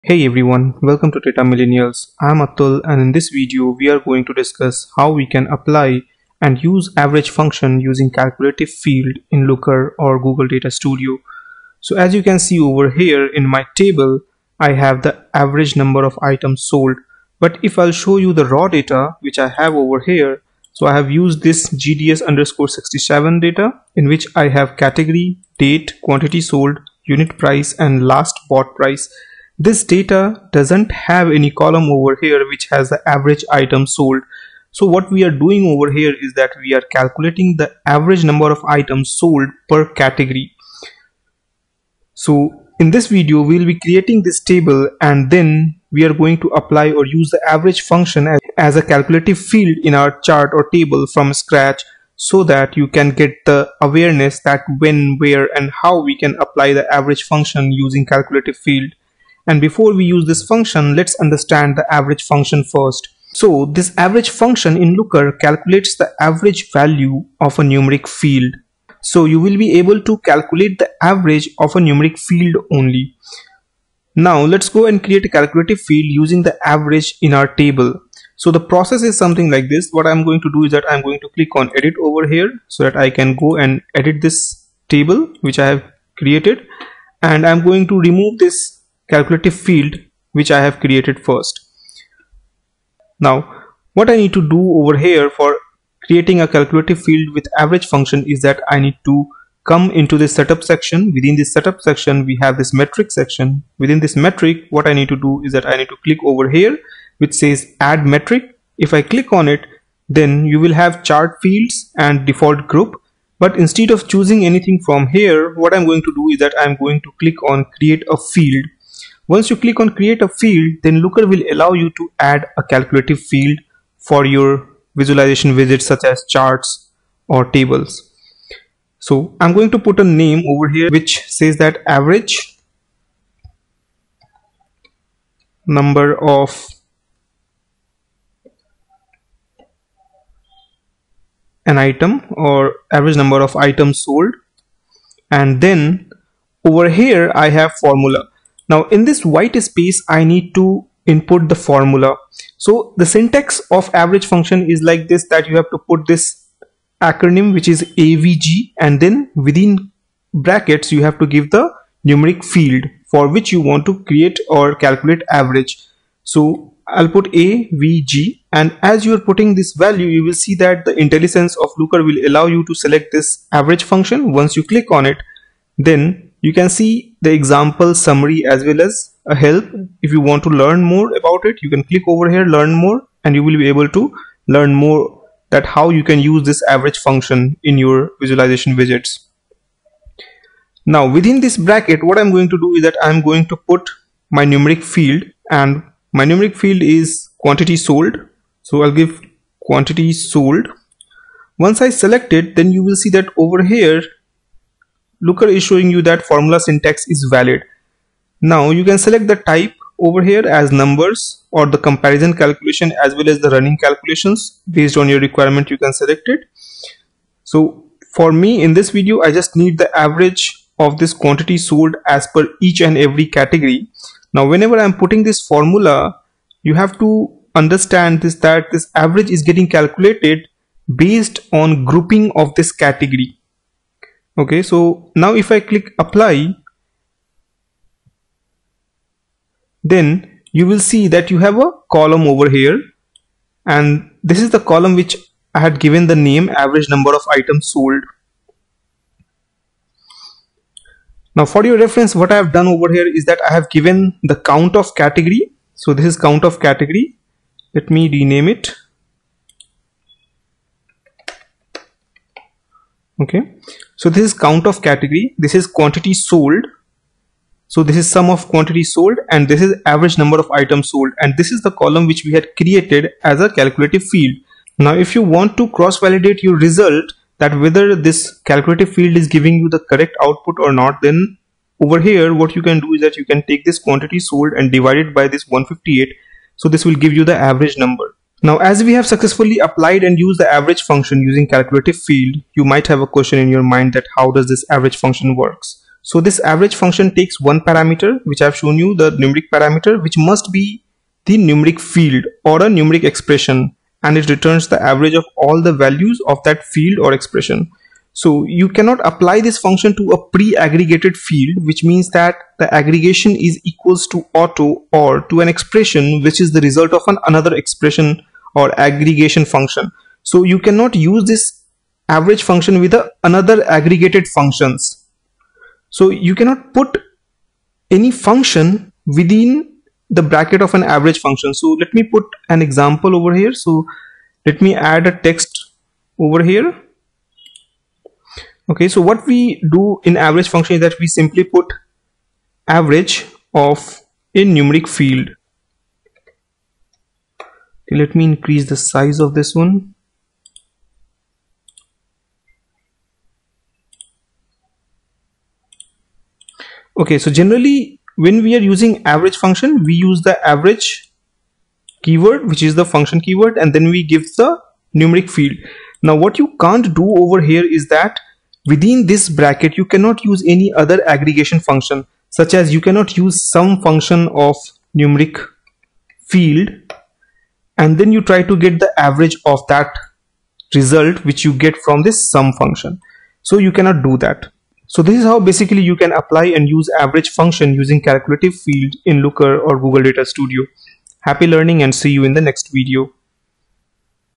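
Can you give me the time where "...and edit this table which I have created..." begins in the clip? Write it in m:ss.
1:23.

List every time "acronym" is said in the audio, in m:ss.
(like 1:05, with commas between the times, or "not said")
2:37.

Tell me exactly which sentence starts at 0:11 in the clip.
So as you can see over here in my table, I have the average number of items sold.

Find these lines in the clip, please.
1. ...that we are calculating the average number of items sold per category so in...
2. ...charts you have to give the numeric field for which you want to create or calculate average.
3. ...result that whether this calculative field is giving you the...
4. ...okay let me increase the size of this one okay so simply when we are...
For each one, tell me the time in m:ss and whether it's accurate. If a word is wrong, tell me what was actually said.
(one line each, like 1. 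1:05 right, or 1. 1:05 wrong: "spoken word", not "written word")
1. 0:36 right
2. 2:40 wrong: "brackets", not "charts"
3. 4:36 right
4. 5:47 wrong: "generally", not "simply".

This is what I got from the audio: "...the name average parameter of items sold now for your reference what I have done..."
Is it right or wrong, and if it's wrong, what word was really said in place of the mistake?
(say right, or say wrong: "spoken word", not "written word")
wrong: "number", not "parameter".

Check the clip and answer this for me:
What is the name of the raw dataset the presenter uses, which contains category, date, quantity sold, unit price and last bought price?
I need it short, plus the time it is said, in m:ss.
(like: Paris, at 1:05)
GDS_67, at 0:21.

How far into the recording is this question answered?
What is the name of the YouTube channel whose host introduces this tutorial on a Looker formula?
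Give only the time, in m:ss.
0:01.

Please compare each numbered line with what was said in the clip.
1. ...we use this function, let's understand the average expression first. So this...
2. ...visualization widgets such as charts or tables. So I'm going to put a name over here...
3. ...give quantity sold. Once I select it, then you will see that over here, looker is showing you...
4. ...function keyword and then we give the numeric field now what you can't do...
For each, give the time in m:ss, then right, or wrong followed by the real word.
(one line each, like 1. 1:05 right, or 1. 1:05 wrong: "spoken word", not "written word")
1. 0:59 wrong: "function", not "expression"
2. 2:04 right
3. 3:18 right
4. 6:02 right.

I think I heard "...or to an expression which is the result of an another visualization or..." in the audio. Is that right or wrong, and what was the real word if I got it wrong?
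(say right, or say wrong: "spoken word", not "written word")
wrong: "expression", not "visualization".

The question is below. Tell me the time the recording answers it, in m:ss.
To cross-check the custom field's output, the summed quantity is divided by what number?
4:45.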